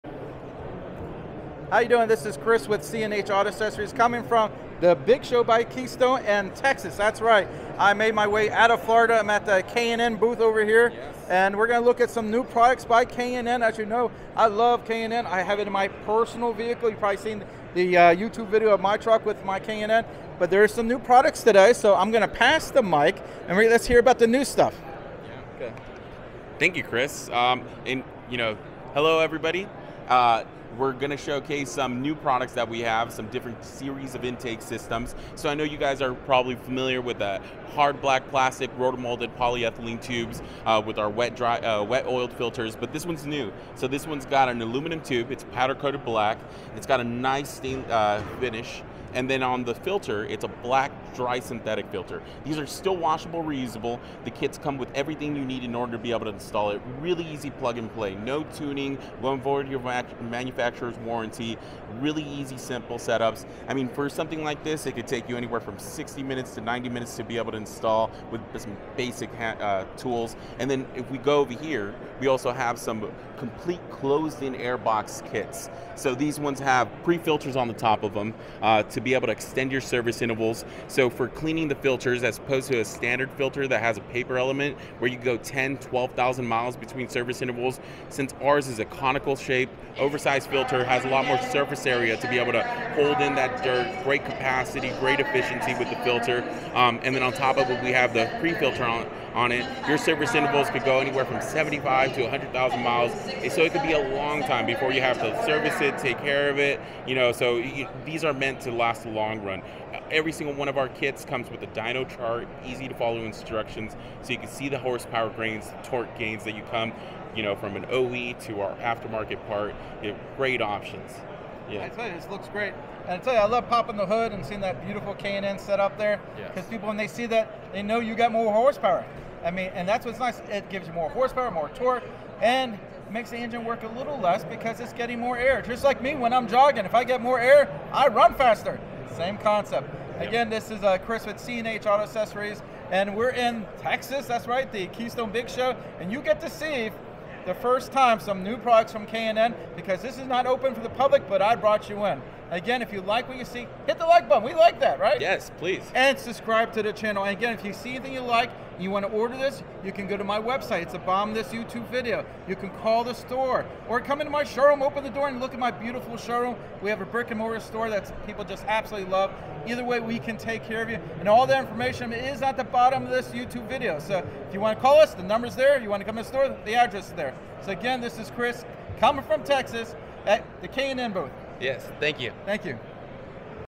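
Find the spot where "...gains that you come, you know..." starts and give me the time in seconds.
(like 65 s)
116 s.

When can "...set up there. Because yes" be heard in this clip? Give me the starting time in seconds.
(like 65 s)
125 s.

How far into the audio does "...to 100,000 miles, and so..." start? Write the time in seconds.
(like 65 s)
102 s.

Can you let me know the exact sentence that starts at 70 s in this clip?
And then if we go over here, we also have some complete closed-in airbox kits.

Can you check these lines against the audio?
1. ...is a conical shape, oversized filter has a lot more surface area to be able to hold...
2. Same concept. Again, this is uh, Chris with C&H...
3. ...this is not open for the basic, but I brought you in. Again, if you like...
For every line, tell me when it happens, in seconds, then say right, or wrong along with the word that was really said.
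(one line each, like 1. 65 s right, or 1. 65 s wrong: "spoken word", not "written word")
1. 88 s right
2. 139 s right
3. 150 s wrong: "public", not "basic".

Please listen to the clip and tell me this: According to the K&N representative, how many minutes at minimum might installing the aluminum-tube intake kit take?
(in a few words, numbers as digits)
60.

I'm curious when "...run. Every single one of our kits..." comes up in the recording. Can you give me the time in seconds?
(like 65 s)
109 s.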